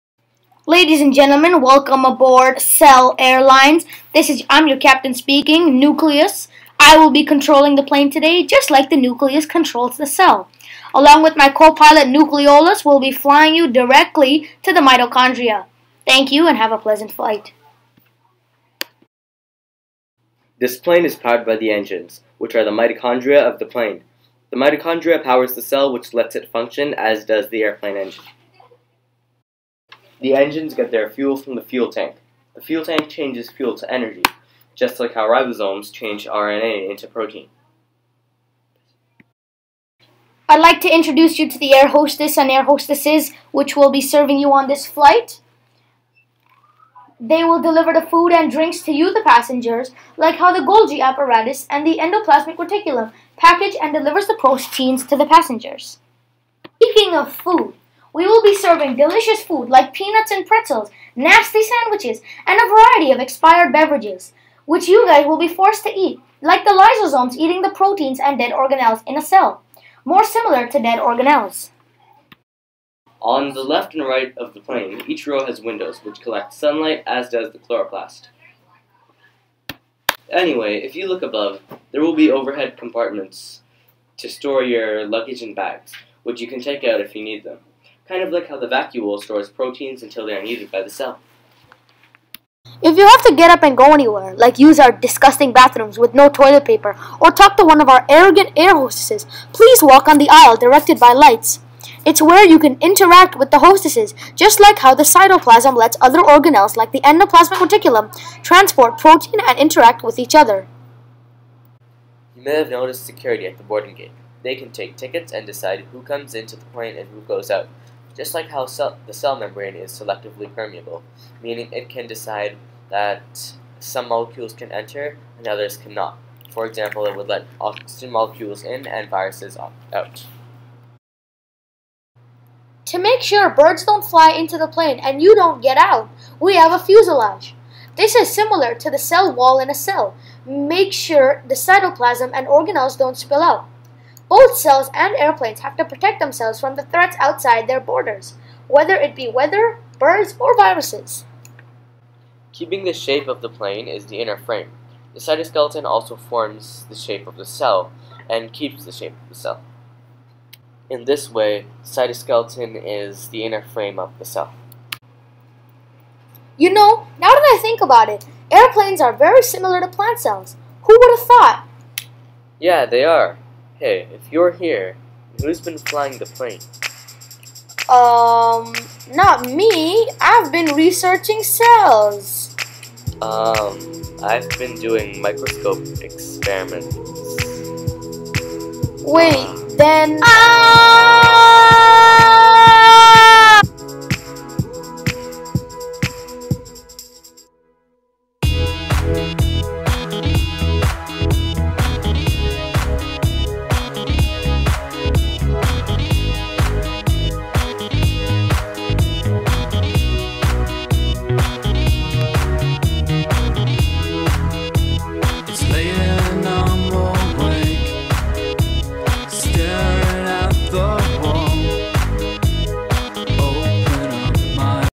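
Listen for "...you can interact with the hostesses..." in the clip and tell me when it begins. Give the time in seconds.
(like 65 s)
102 s.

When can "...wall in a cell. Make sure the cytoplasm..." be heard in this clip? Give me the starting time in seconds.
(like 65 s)
139 s.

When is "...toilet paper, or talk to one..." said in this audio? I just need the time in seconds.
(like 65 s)
96 s.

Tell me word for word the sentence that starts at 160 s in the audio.
In this way, cytoskeleton is the inner frame of the cell.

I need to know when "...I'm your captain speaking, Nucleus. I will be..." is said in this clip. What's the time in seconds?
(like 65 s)
4 s.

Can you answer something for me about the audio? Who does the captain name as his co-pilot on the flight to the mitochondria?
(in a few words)
Nucleolus.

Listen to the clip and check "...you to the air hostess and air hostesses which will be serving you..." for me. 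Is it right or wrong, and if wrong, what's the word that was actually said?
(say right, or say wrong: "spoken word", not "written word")
right.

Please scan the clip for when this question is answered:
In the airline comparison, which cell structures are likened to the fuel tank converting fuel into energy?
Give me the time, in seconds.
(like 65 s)
35 s.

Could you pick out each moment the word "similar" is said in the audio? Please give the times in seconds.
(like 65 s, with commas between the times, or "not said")
70 s, 138 s, 169 s.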